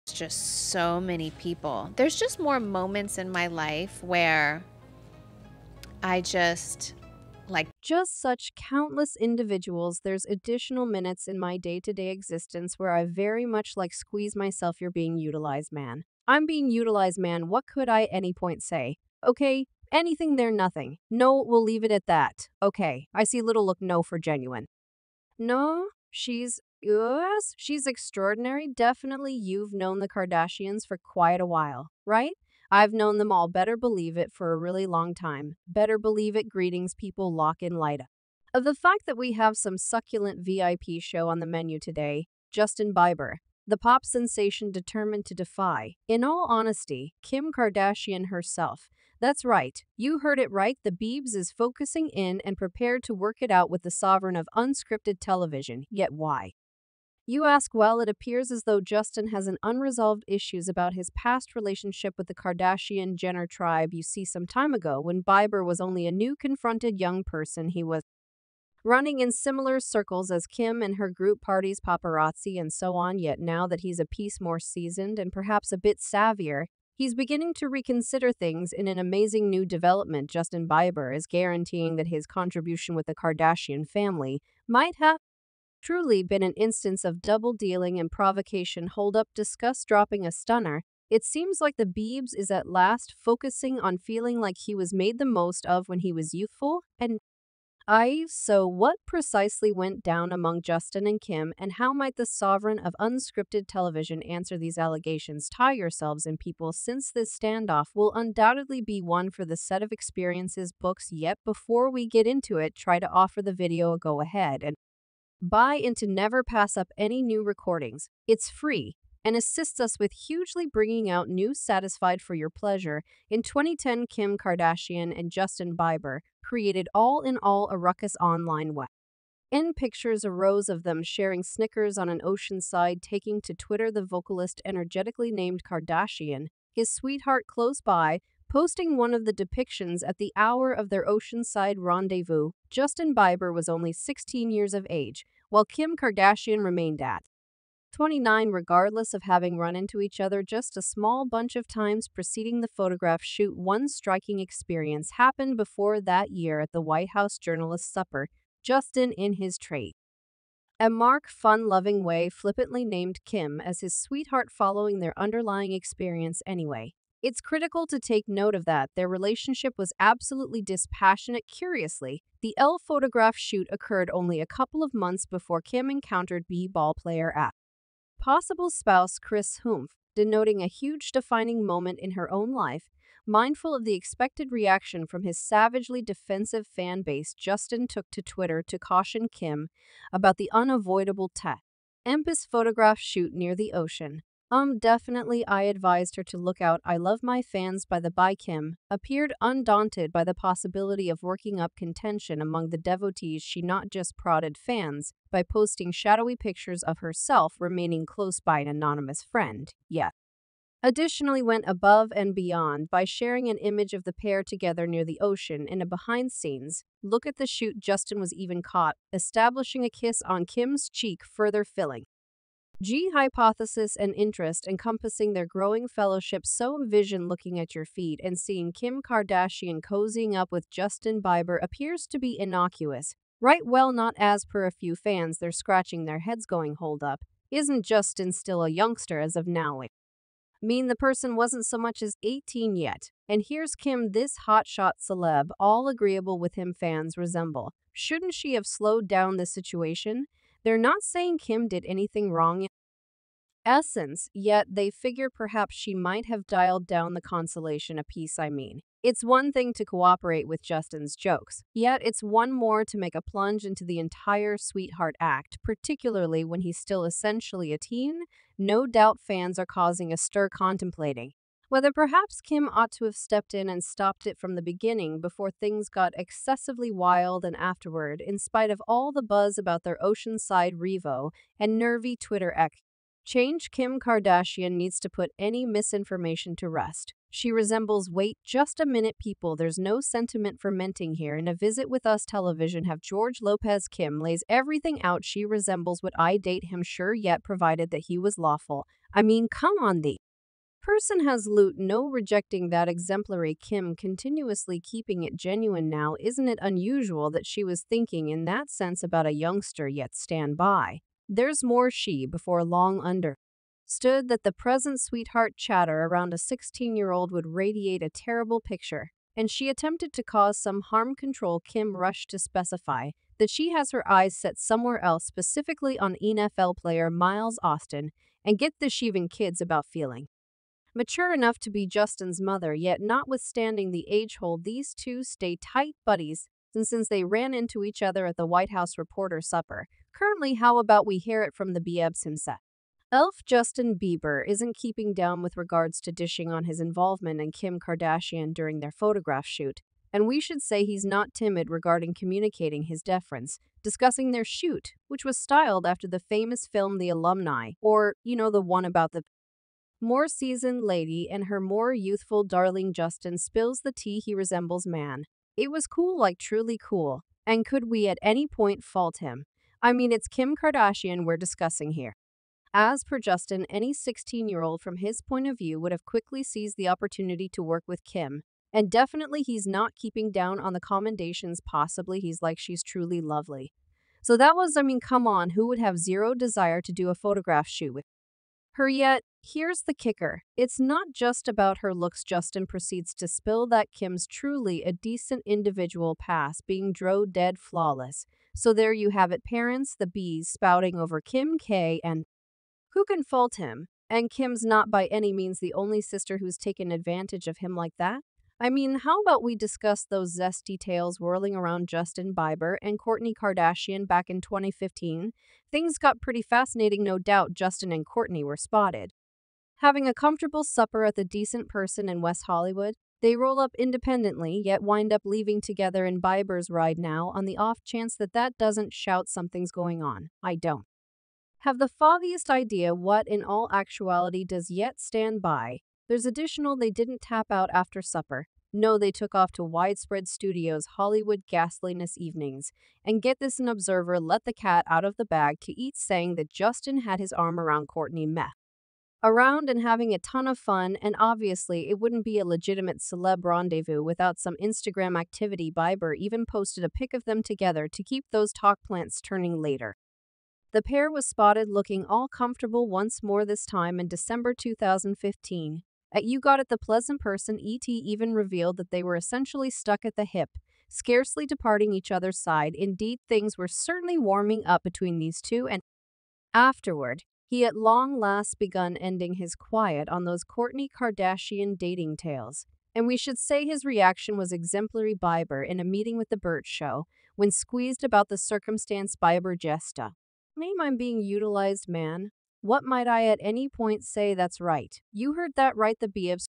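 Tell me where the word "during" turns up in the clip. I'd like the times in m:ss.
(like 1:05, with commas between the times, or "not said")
5:48.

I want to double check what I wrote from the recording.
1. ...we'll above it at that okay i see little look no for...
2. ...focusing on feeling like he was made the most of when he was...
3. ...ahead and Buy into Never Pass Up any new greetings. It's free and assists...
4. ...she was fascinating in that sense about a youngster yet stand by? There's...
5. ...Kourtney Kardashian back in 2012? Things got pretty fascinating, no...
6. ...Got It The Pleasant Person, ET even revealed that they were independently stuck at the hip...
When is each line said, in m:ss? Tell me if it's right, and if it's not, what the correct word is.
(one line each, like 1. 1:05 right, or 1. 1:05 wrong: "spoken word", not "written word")
1. 0:21 wrong: "leave", not "above"
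2. 1:33 right
3. 1:54 wrong: "recordings", not "greetings"
4. 5:07 wrong: "thinking", not "fascinating"
5. 6:52 wrong: "2015", not "2012"
6. 7:46 wrong: "essentially", not "independently".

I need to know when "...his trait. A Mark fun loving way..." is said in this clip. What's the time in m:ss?
2:39.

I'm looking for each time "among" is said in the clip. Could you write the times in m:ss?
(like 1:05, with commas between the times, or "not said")
1:40, 3:22.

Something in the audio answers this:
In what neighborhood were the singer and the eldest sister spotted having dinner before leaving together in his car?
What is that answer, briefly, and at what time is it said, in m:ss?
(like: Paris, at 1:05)
West Hollywood, at 7:02.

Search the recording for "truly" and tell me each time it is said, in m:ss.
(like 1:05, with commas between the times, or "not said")
1:25, 6:06, 6:22, 6:34.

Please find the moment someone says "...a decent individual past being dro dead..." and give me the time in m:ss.
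6:34.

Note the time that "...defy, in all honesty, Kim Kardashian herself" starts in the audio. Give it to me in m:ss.
0:45.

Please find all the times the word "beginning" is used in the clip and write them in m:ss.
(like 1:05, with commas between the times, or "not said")
1:17, 4:34.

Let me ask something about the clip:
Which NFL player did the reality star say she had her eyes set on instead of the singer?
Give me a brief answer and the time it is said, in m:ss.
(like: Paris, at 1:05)
Miles Austin, at 5:27.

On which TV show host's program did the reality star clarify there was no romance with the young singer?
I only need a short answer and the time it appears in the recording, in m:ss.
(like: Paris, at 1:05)
George Lopez, at 4:52.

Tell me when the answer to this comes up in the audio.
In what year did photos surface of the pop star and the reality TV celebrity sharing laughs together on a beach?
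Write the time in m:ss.
2:03.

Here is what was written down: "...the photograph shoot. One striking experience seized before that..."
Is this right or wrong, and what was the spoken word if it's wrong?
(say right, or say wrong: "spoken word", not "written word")
wrong: "happened", not "seized".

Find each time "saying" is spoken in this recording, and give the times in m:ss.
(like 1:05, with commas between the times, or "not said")
4:11, 7:25.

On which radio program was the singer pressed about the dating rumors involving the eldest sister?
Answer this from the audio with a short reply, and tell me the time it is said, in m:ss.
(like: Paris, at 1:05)
The Bert Show, at 8:06.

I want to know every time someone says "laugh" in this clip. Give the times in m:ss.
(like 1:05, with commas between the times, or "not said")
not said.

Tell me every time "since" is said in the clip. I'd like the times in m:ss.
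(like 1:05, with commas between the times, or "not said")
1:46, 5:36.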